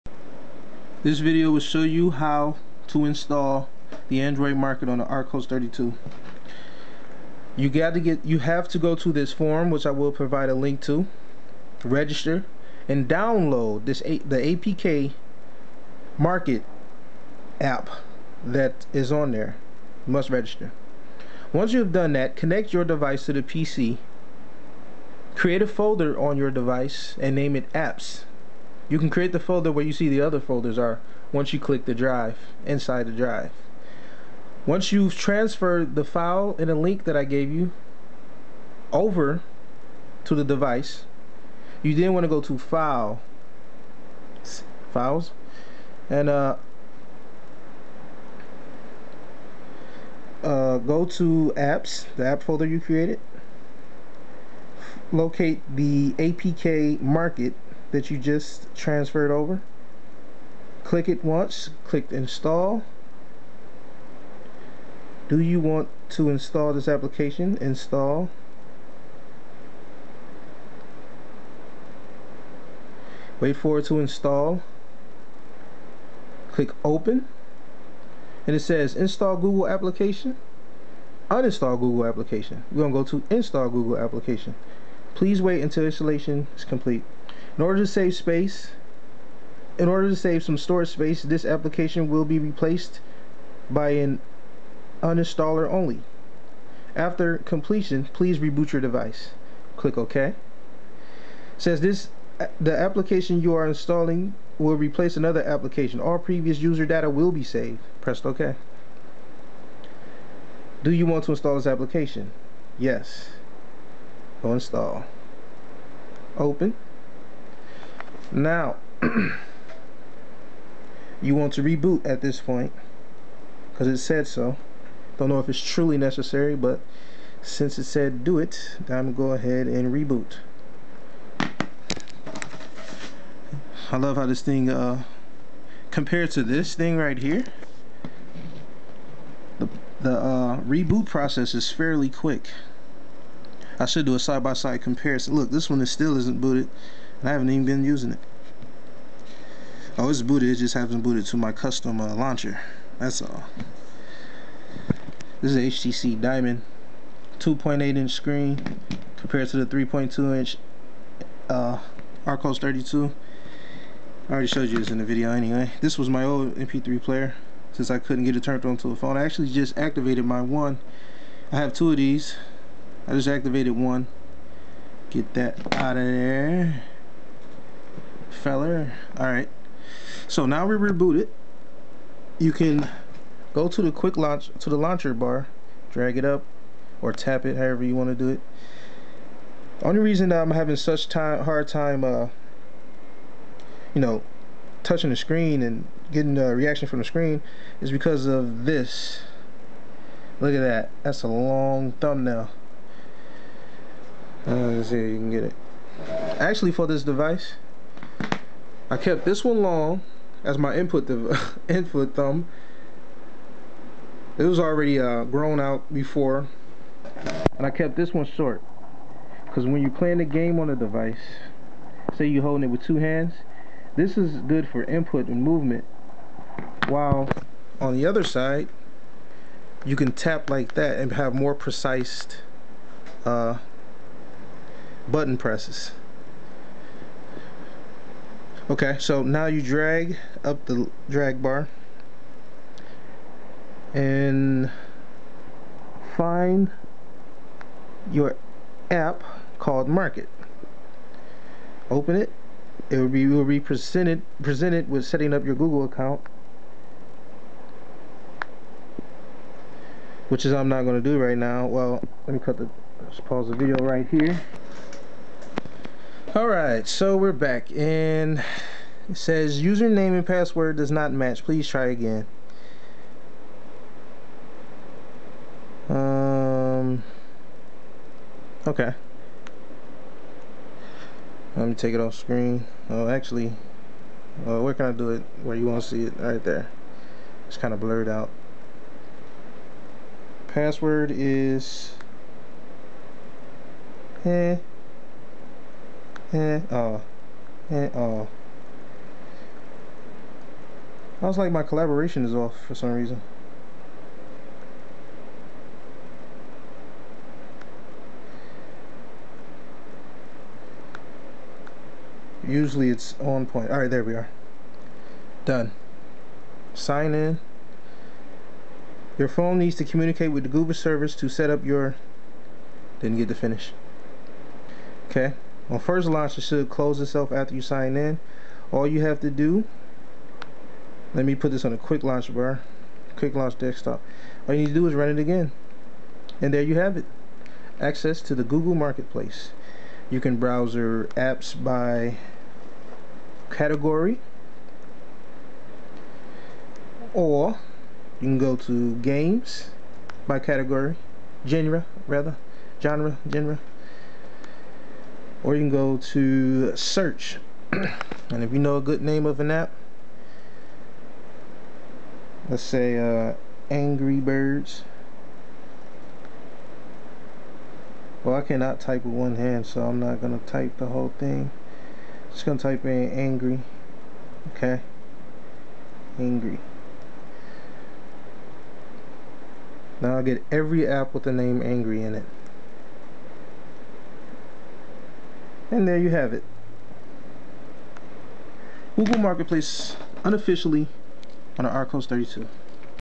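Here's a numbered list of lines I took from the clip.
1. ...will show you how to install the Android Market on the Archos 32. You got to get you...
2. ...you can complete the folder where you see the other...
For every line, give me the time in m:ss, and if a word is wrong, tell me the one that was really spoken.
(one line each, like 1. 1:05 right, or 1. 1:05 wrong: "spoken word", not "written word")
1. 0:01 right
2. 0:28 wrong: "create", not "complete".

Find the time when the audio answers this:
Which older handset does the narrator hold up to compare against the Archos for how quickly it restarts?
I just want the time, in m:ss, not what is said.
2:35.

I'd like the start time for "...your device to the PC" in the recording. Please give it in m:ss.
0:22.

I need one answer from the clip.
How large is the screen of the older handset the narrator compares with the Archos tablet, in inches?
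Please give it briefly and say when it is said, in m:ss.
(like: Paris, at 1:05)
2.8 inches, at 2:37.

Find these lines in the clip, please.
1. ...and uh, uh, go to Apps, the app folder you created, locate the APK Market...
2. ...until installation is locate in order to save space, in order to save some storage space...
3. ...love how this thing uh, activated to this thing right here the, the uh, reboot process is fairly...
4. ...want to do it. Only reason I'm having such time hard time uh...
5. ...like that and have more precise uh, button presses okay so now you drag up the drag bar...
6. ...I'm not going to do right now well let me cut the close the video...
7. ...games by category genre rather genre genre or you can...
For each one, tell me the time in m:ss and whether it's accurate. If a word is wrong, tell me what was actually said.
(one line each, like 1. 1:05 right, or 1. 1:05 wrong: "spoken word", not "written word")
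1. 0:46 right
2. 1:25 wrong: "complete", not "locate"
3. 2:13 wrong: "compared", not "activated"
4. 3:07 right
5. 3:50 right
6. 4:20 wrong: "pause", not "close"
7. 5:48 right.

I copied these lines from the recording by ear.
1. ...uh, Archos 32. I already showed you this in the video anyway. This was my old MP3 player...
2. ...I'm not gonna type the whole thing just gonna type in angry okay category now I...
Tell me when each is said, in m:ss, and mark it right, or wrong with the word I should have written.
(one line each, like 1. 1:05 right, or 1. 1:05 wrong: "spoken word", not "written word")
1. 2:41 right
2. 6:09 wrong: "angry", not "category".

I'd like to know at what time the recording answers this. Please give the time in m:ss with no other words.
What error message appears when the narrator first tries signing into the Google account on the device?
4:29.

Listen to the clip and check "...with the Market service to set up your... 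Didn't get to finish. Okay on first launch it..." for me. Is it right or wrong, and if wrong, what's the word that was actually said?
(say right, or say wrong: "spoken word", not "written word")
wrong: "Google", not "Market".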